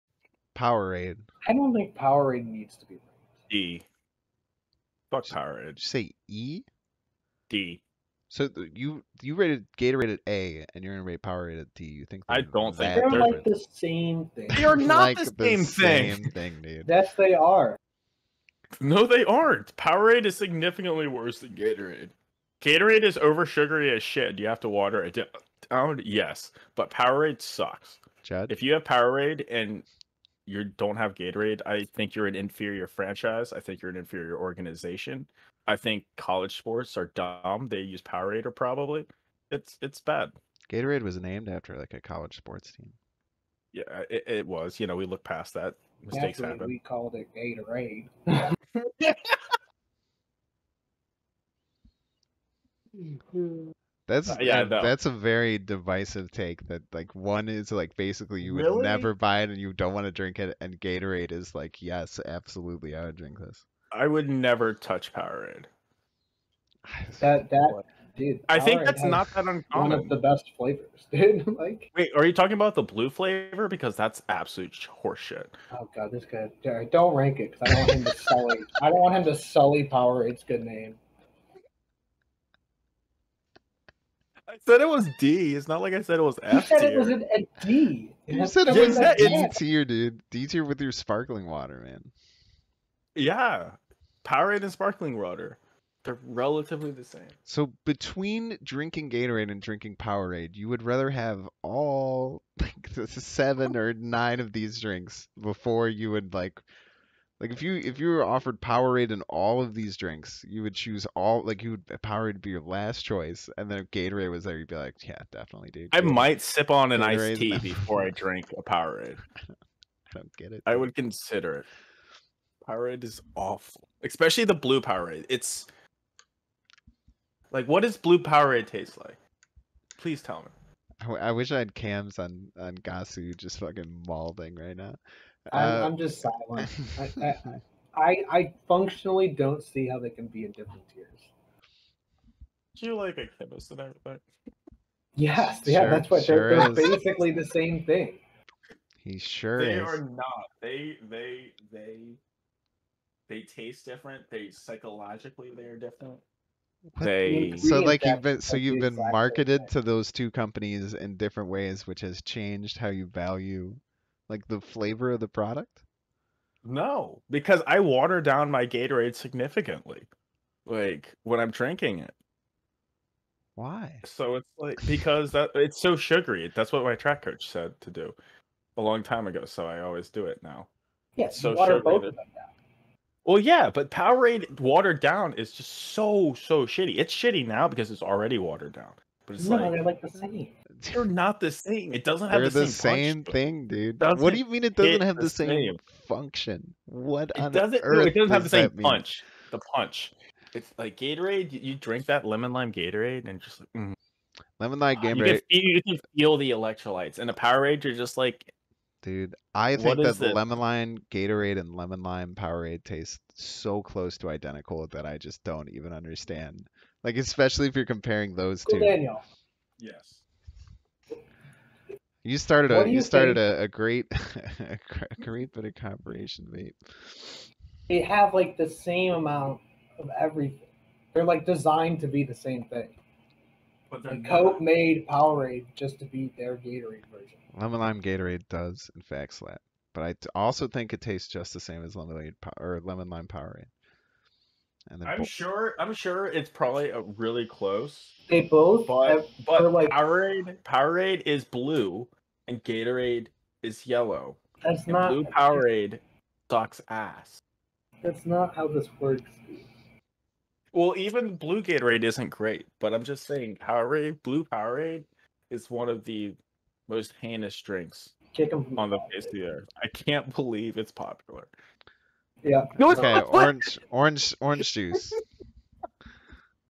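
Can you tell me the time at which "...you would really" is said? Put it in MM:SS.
00:58.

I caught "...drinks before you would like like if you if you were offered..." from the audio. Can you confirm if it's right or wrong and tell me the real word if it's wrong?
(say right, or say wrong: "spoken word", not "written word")
right.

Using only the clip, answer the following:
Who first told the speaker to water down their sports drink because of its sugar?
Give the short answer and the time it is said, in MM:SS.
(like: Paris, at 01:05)
Track coach, at 02:56.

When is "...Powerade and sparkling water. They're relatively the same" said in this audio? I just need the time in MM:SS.
01:34.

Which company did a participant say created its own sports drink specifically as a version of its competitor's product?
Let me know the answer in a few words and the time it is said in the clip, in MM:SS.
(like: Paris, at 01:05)
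Coke, at 03:54.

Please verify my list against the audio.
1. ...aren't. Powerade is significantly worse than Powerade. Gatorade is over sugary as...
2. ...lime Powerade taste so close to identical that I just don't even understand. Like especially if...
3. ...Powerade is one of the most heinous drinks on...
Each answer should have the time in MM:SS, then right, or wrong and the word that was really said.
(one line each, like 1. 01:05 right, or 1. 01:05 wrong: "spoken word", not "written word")
1. 00:19 wrong: "Gatorade", not "Powerade"
2. 03:32 right
3. 04:24 right.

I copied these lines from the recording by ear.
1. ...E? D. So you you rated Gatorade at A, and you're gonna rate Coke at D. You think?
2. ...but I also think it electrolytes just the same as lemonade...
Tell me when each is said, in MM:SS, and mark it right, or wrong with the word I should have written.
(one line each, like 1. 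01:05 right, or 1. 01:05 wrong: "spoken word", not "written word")
1. 00:06 wrong: "Powerade", not "Coke"
2. 03:59 wrong: "tastes", not "electrolytes".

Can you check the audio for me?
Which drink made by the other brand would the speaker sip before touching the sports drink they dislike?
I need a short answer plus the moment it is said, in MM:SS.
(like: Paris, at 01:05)
Gatorade iced tea, at 01:57.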